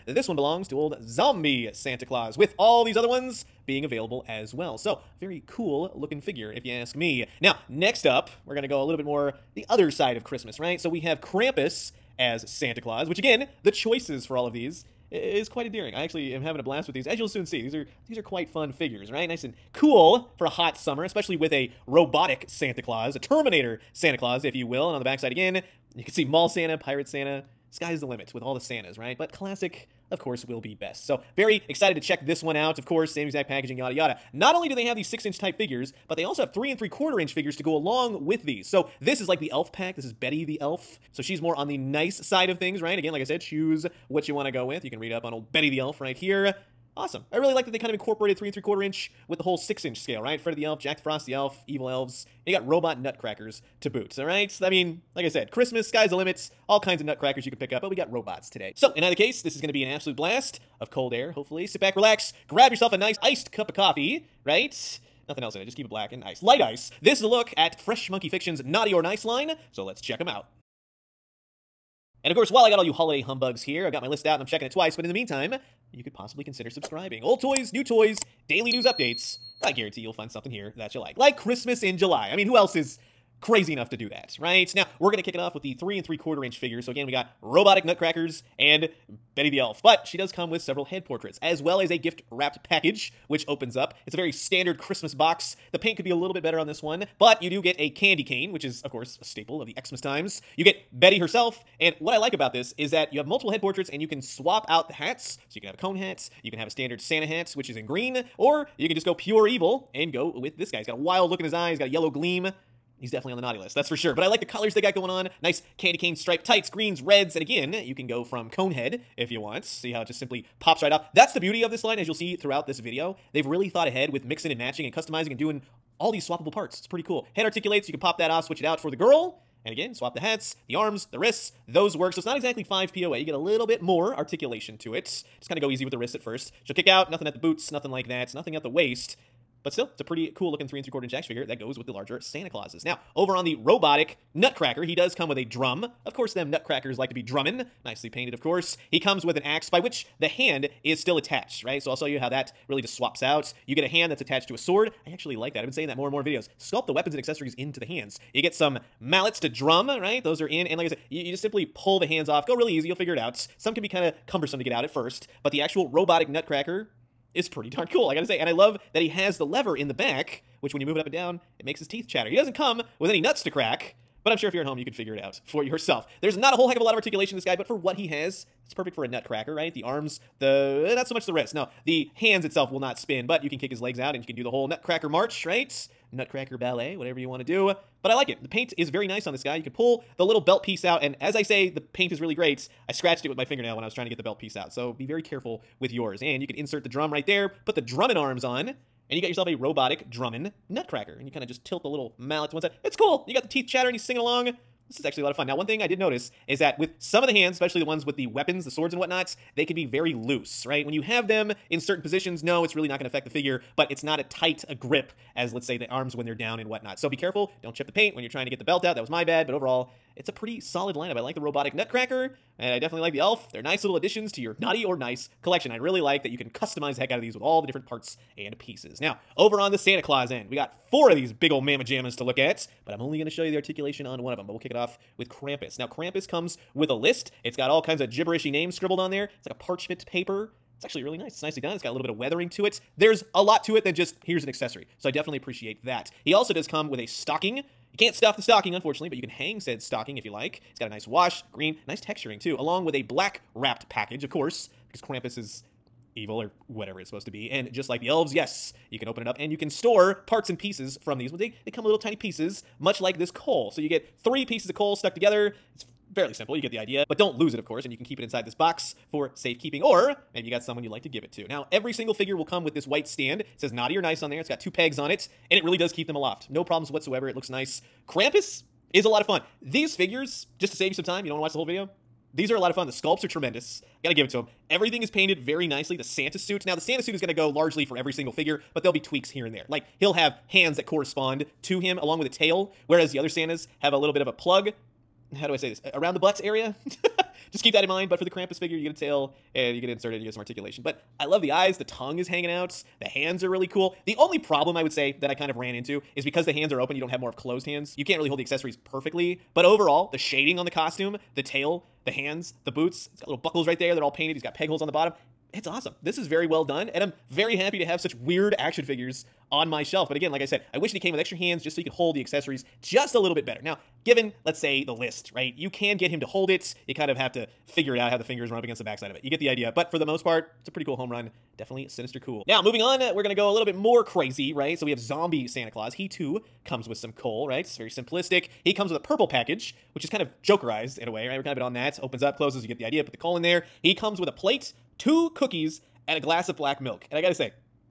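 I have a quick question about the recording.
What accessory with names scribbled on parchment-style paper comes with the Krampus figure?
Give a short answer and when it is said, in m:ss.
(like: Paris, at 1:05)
a list, at 3:56.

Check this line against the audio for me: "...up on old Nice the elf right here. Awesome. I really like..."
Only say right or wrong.
wrong.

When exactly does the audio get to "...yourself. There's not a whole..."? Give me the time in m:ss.
2:55.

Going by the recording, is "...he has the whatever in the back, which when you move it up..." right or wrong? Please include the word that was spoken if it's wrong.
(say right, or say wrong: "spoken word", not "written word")
wrong: "lever", not "whatever".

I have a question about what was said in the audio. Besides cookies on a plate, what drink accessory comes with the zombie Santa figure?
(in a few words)
a glass of black milk.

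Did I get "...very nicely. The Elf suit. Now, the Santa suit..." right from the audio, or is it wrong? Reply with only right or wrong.
wrong.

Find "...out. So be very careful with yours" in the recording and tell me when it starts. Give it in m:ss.
3:14.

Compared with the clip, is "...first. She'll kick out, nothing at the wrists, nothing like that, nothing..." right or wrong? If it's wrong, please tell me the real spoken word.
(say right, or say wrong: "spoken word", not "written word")
wrong: "boots", not "wrists".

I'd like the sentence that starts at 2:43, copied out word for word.
Some can be kind of cumbersome to get out at first.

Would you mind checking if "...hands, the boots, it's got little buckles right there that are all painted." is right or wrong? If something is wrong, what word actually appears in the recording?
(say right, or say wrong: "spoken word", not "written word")
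right.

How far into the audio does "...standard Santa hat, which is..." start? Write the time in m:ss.
1:46.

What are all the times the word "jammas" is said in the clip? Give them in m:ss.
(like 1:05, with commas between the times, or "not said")
3:51.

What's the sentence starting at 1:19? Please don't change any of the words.
I guarantee you'll find something here that you like.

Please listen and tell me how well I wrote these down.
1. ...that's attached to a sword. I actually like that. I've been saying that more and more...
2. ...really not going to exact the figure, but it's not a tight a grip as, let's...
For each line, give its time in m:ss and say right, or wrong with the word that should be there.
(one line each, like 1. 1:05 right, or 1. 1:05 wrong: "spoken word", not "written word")
1. 2:34 right
2. 3:32 wrong: "affect", not "exact".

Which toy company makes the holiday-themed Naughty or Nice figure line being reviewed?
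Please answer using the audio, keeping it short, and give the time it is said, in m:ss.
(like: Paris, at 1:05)
Fresh Monkey Fiction, at 1:07.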